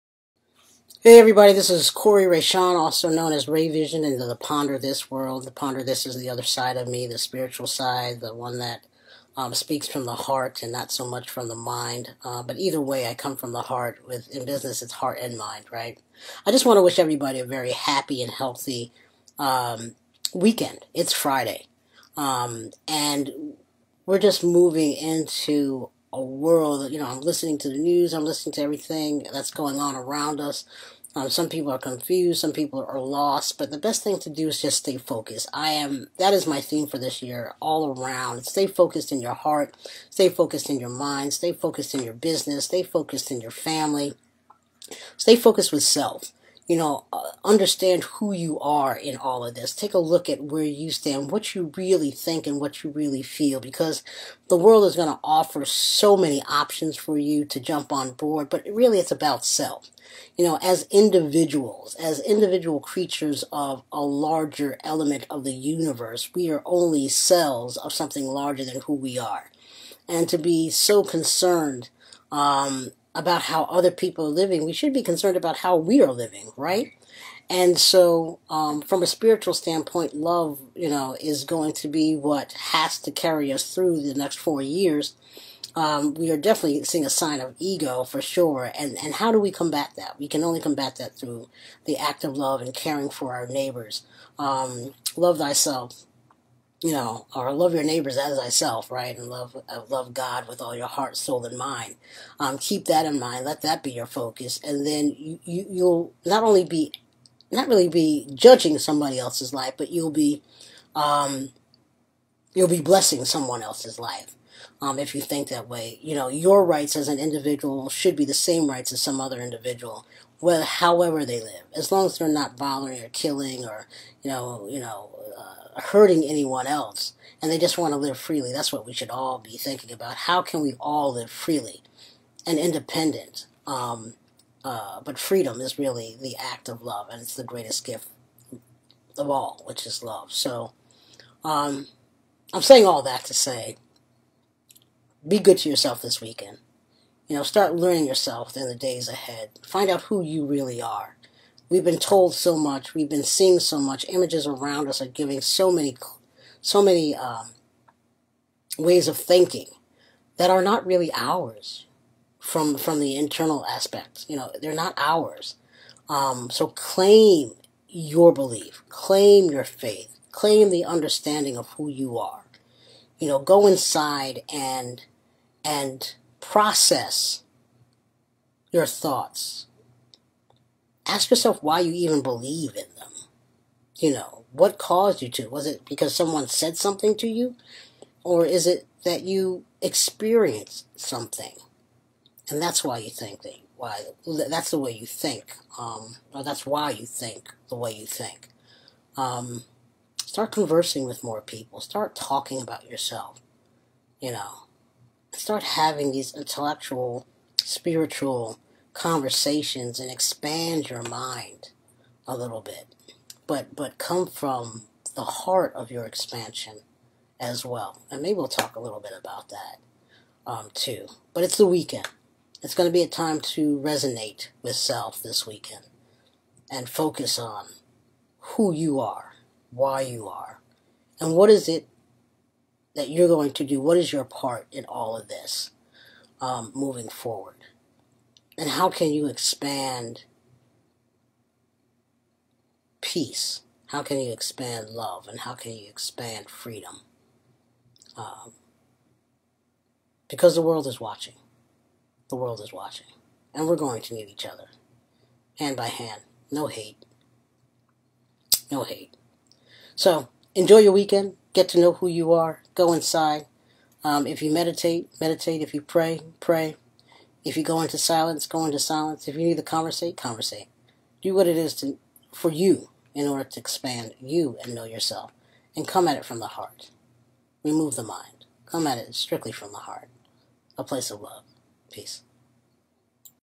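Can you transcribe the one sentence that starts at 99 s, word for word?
And love uh, love God with all your heart, soul, and mind.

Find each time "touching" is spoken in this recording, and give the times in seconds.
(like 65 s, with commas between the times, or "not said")
not said.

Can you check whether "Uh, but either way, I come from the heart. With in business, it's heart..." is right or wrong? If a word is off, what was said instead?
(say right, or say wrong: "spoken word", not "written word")
right.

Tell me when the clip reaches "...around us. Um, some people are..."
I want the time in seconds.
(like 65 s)
29 s.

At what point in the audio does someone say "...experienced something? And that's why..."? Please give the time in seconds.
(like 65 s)
189 s.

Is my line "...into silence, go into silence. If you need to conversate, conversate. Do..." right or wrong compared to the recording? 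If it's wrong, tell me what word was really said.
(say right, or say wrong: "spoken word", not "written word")
right.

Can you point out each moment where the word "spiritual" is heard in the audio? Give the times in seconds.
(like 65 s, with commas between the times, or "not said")
7 s, 79 s, 207 s.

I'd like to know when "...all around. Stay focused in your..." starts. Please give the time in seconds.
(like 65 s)
37 s.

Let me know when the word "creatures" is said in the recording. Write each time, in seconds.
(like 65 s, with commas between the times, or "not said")
62 s.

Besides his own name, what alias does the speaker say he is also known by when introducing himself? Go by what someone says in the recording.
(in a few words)
Ray Vision.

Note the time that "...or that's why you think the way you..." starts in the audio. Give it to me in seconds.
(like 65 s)
196 s.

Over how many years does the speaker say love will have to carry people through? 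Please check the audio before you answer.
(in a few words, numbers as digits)
4.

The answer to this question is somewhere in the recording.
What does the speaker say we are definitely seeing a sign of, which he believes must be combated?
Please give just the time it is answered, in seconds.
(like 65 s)
87 s.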